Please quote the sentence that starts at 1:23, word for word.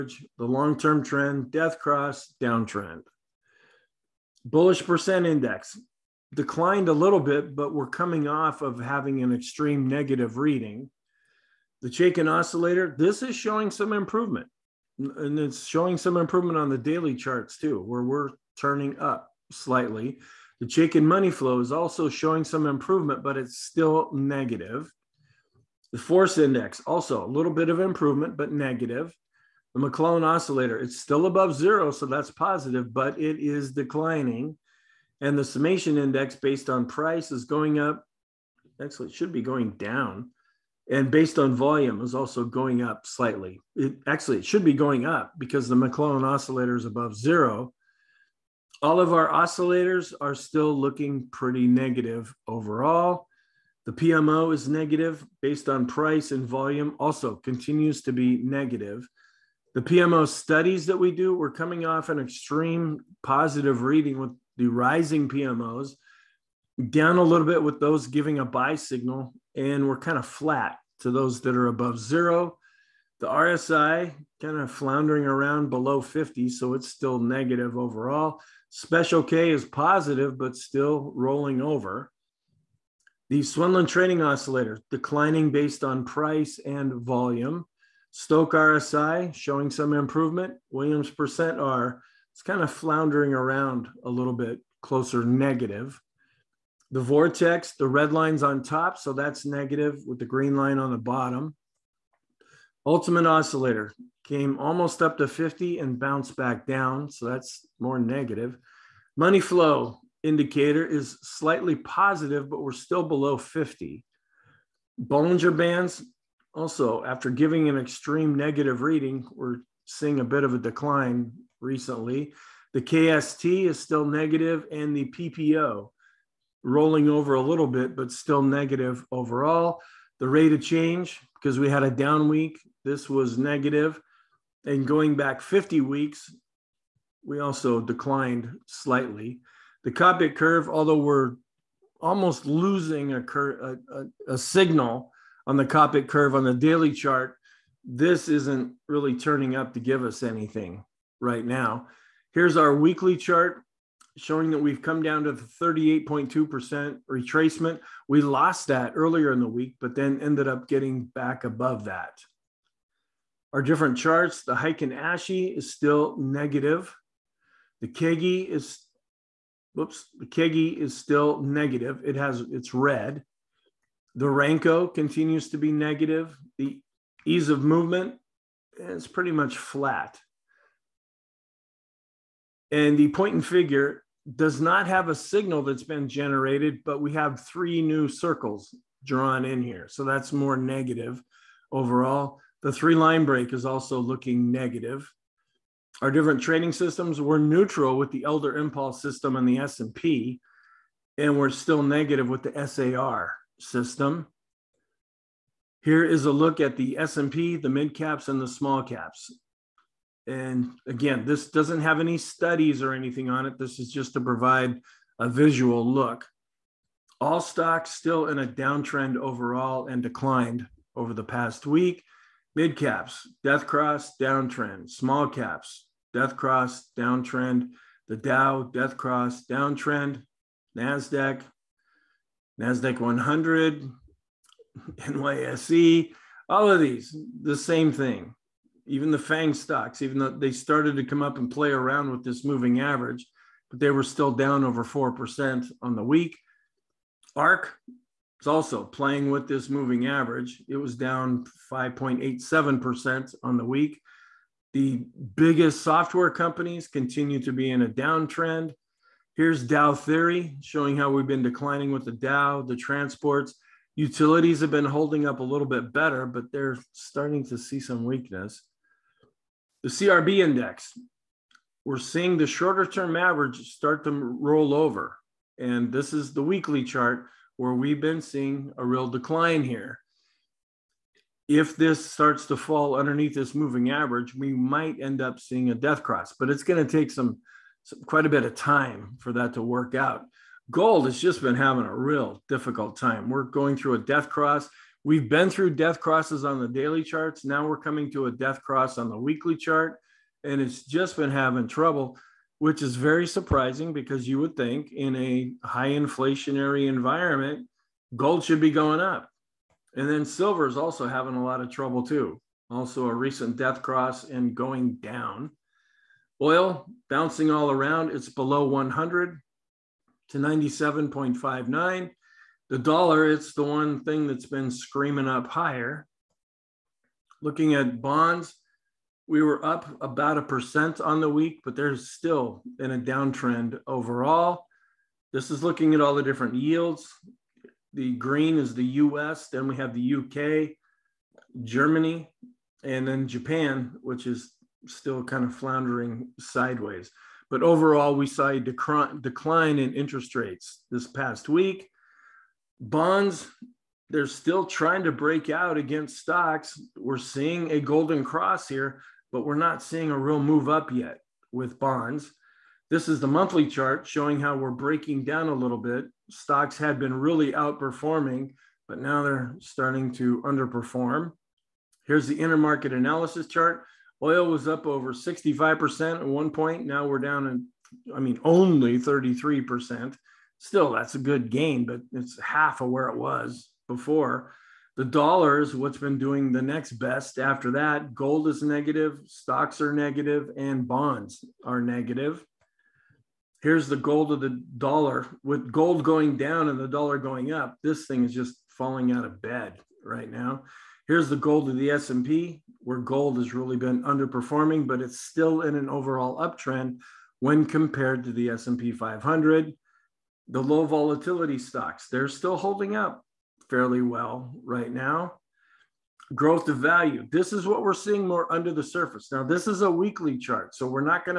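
The Swenlin Trading Oscillator declining based on price and volume.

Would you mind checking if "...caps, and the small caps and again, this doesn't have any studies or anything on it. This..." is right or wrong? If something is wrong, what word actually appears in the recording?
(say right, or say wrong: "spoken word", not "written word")
right.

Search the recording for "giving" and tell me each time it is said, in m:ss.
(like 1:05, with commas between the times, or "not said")
1:08, 1:57.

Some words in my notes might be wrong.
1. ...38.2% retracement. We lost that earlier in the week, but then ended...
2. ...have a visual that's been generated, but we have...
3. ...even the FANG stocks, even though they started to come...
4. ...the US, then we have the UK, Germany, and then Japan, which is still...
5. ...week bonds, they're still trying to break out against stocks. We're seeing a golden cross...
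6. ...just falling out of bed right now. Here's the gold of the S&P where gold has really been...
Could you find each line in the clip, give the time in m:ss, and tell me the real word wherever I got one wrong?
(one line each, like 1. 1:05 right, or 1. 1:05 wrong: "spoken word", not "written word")
1. 2:35 right
2. 3:04 wrong: "signal", not "visual"
3. 3:58 right
4. 5:38 right
5. 5:51 right
6. 6:38 right.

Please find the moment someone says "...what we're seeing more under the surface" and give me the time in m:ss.
6:57.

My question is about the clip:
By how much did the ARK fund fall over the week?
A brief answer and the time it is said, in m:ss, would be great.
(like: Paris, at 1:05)
5.87%, at 4:11.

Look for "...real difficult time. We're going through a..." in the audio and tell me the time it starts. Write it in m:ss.
4:51.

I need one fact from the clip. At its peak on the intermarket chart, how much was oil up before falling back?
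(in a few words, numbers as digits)
over 65%.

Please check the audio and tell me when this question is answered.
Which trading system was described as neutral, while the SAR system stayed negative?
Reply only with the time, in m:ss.
3:18.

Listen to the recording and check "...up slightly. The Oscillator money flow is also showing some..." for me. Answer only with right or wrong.
wrong.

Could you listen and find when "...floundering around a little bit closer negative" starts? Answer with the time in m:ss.
1:32.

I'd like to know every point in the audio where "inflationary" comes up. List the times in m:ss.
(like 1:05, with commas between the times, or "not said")
5:05.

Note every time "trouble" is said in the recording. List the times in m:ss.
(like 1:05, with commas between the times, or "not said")
5:01, 5:11.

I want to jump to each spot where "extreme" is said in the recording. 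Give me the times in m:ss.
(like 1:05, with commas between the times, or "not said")
0:09, 1:02, 1:57.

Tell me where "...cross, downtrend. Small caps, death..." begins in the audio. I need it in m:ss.
3:43.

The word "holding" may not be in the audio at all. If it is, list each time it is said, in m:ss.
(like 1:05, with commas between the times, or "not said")
4:24, 6:52.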